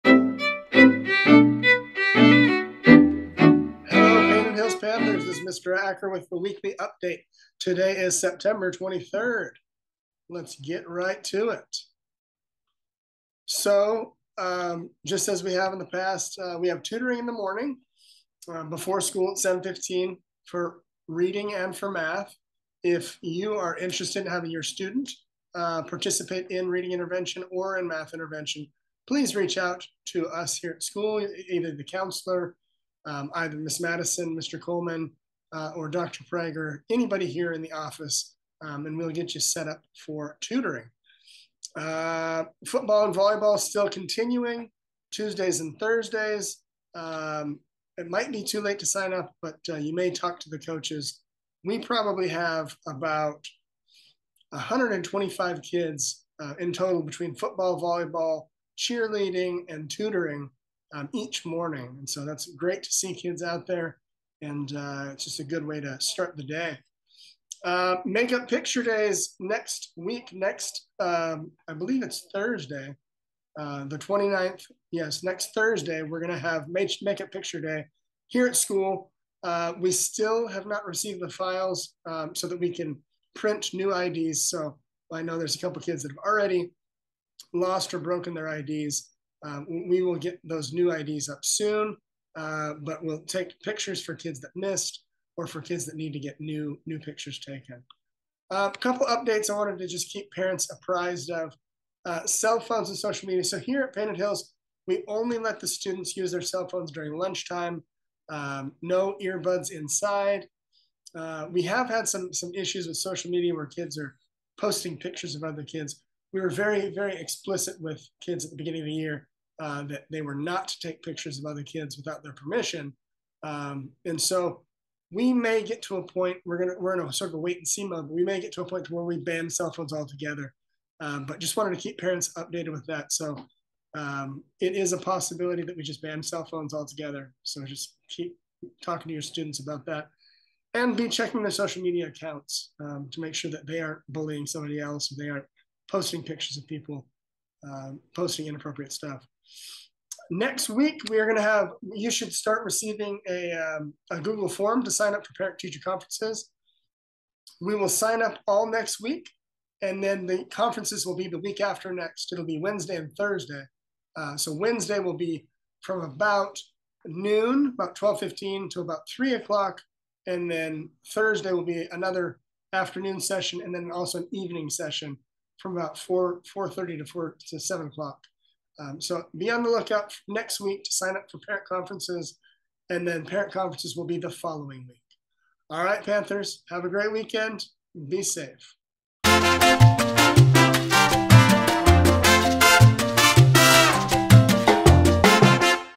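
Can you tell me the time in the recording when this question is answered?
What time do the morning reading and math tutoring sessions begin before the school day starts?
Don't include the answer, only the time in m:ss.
0:19.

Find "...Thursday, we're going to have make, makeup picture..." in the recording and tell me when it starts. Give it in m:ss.
1:15.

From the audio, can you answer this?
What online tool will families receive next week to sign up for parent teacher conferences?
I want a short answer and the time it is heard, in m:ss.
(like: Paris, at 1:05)
Google form, at 2:34.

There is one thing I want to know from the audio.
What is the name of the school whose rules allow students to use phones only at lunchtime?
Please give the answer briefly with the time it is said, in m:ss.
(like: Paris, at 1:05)
Painted Hills, at 1:43.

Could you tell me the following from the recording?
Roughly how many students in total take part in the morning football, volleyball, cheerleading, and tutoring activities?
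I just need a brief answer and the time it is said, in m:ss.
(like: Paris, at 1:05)
125, at 0:54.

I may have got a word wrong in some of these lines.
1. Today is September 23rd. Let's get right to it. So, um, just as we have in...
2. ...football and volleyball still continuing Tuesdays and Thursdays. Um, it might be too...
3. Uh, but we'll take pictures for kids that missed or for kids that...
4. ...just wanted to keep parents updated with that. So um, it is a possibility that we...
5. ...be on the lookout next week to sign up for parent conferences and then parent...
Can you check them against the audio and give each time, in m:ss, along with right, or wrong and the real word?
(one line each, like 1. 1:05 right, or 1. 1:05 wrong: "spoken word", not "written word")
1. 0:07 right
2. 0:42 right
3. 1:32 right
4. 2:11 right
5. 2:59 right.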